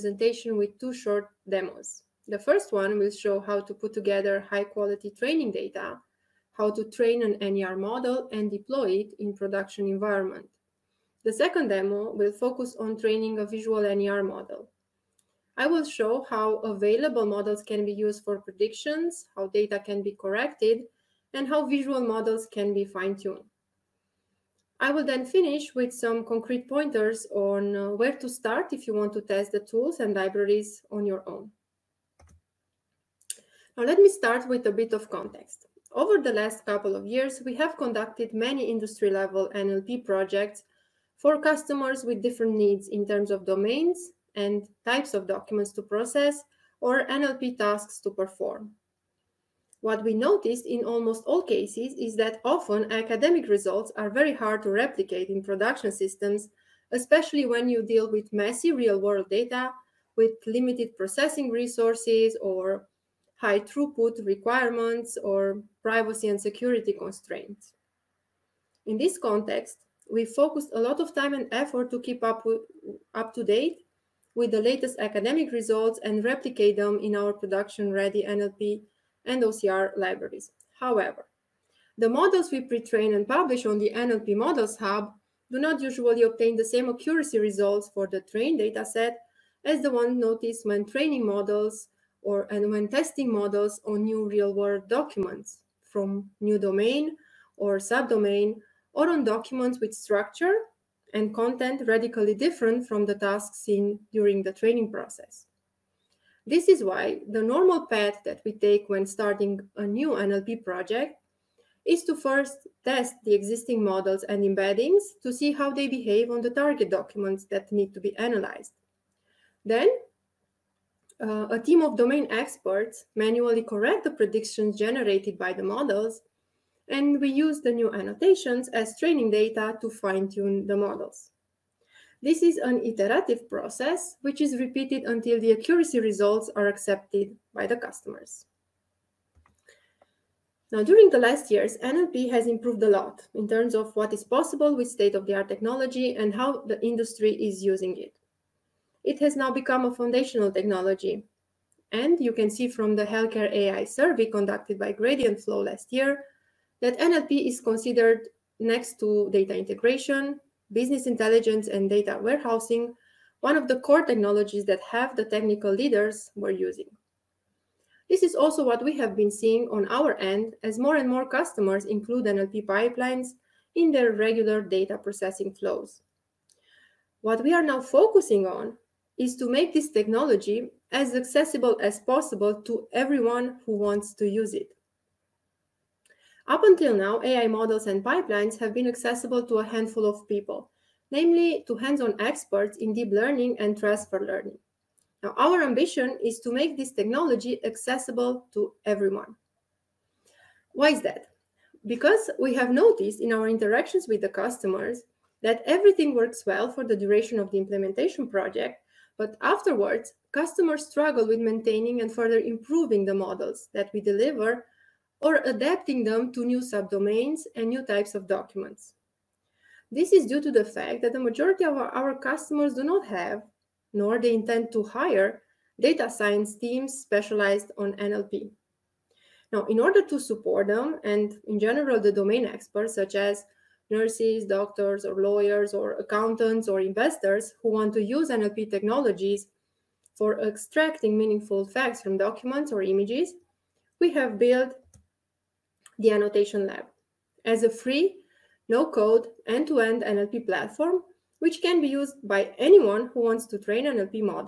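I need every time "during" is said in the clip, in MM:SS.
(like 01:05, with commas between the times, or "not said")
01:44, 02:20.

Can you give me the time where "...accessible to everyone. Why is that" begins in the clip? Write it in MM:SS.
03:17.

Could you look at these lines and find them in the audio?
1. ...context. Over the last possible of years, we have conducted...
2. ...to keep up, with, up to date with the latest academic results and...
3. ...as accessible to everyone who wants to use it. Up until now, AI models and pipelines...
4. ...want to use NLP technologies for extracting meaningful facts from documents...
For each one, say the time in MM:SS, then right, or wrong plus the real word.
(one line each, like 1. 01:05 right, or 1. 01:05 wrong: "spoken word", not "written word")
1. 00:35 wrong: "couple", not "possible"
2. 01:11 right
3. 03:01 wrong: "possible", not "accessible"
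4. 03:57 right.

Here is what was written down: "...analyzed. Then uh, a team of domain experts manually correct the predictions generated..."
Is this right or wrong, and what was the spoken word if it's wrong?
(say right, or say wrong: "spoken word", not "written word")
right.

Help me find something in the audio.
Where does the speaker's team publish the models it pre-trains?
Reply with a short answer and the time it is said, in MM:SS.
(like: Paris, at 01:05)
NLP Models Hub, at 01:23.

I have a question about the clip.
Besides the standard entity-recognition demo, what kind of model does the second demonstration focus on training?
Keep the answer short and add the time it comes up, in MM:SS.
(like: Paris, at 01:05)
visual NER model, at 00:13.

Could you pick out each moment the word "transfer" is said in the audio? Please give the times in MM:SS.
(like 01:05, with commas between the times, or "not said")
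03:13.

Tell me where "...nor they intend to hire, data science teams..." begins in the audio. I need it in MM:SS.
03:43.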